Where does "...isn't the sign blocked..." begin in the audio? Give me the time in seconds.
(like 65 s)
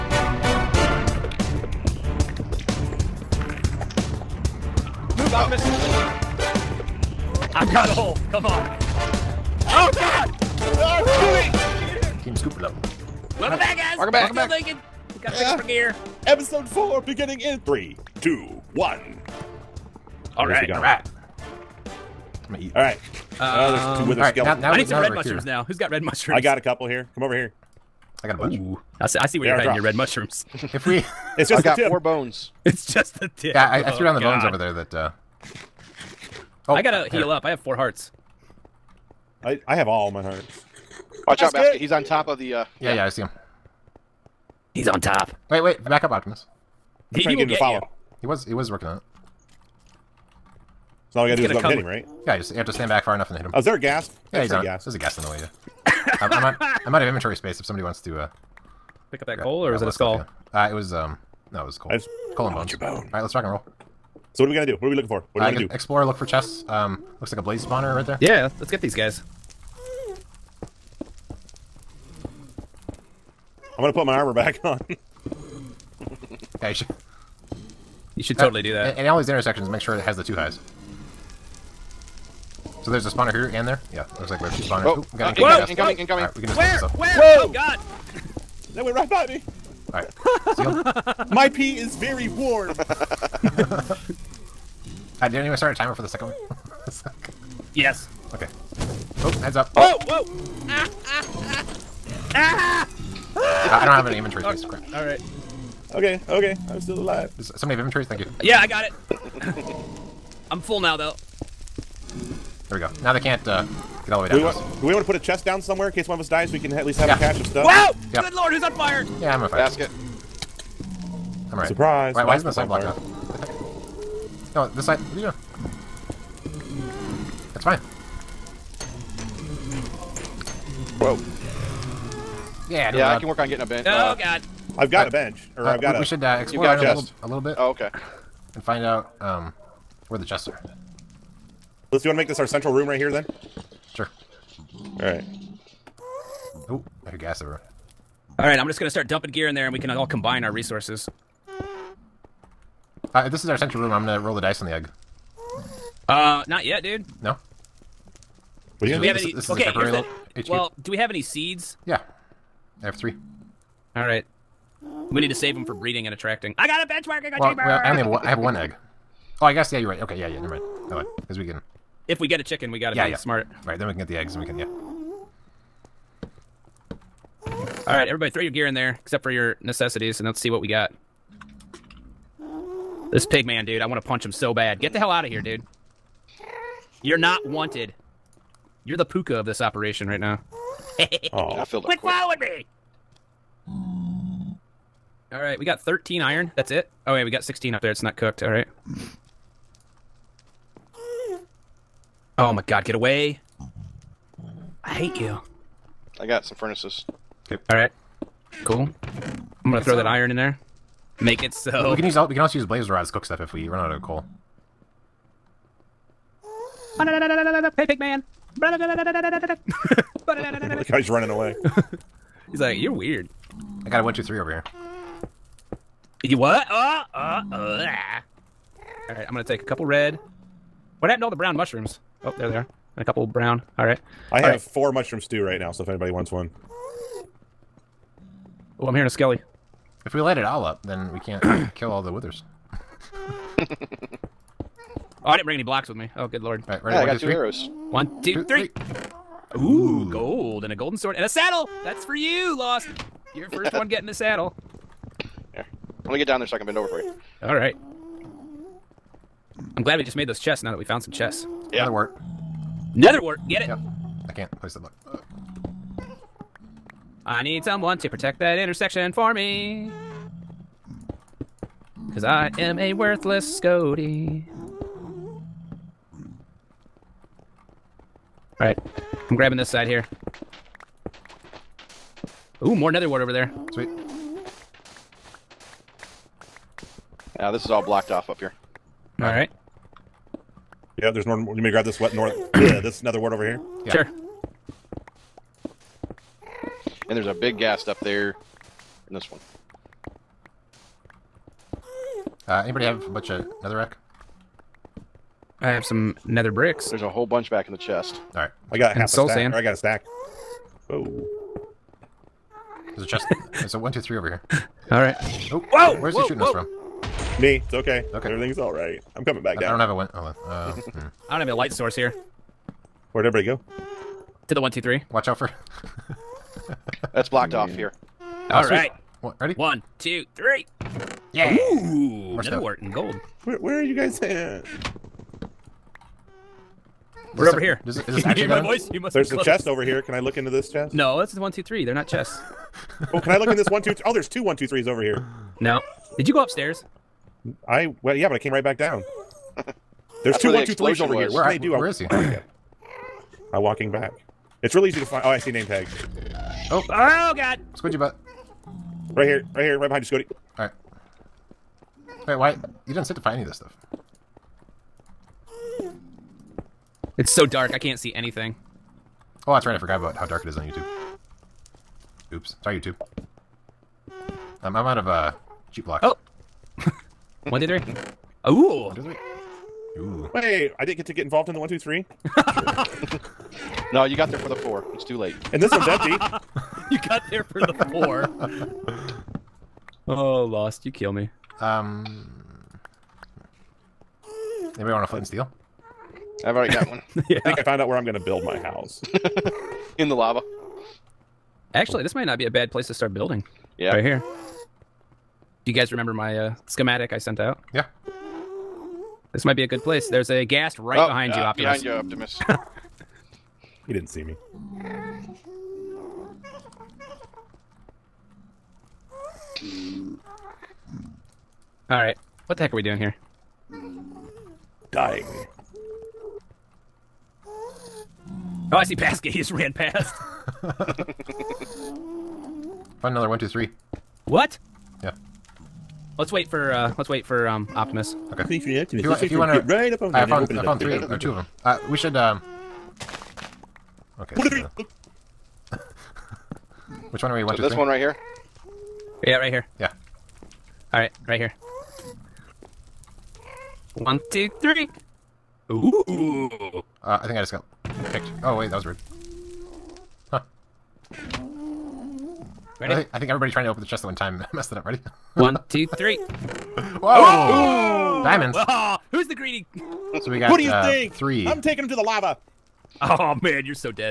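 122 s.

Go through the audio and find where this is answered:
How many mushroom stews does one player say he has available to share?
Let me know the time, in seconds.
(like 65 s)
234 s.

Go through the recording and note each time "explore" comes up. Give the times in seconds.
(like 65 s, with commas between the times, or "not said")
65 s, 136 s.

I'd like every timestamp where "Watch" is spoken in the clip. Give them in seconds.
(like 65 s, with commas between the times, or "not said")
41 s, 325 s.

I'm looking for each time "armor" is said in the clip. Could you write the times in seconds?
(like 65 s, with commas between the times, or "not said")
74 s.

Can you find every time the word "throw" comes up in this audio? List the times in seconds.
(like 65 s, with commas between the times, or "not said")
178 s, 209 s.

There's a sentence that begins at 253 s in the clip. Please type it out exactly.
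Your first one getting the saddle.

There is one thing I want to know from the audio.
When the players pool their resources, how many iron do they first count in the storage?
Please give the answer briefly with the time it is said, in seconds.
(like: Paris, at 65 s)
13, at 195 s.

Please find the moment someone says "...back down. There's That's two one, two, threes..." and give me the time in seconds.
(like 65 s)
348 s.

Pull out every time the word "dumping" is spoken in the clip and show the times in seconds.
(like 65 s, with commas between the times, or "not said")
149 s.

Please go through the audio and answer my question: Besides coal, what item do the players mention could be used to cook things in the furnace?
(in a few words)
blaze rods.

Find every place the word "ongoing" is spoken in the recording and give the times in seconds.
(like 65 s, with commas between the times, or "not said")
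not said.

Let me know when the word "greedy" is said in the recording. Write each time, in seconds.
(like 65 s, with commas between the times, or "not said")
469 s.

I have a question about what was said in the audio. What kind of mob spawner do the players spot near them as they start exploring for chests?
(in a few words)
blaze spawner.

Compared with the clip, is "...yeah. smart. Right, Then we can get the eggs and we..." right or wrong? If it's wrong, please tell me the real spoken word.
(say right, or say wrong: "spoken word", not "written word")
right.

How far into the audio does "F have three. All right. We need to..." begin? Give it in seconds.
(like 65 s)
162 s.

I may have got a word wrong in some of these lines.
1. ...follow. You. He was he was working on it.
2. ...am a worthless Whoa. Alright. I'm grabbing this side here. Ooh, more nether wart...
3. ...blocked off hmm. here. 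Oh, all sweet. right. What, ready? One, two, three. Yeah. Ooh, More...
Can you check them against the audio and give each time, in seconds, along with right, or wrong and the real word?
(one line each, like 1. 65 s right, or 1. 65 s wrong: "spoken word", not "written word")
1. 47 s right
2. 272 s wrong: "Scotty", not "Whoa"
3. 327 s right.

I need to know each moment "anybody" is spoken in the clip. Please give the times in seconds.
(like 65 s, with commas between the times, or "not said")
235 s, 302 s, 394 s.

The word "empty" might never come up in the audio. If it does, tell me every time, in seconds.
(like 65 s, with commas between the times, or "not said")
385 s.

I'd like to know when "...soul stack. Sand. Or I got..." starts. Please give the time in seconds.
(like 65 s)
309 s.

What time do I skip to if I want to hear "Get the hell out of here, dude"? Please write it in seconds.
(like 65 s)
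184 s.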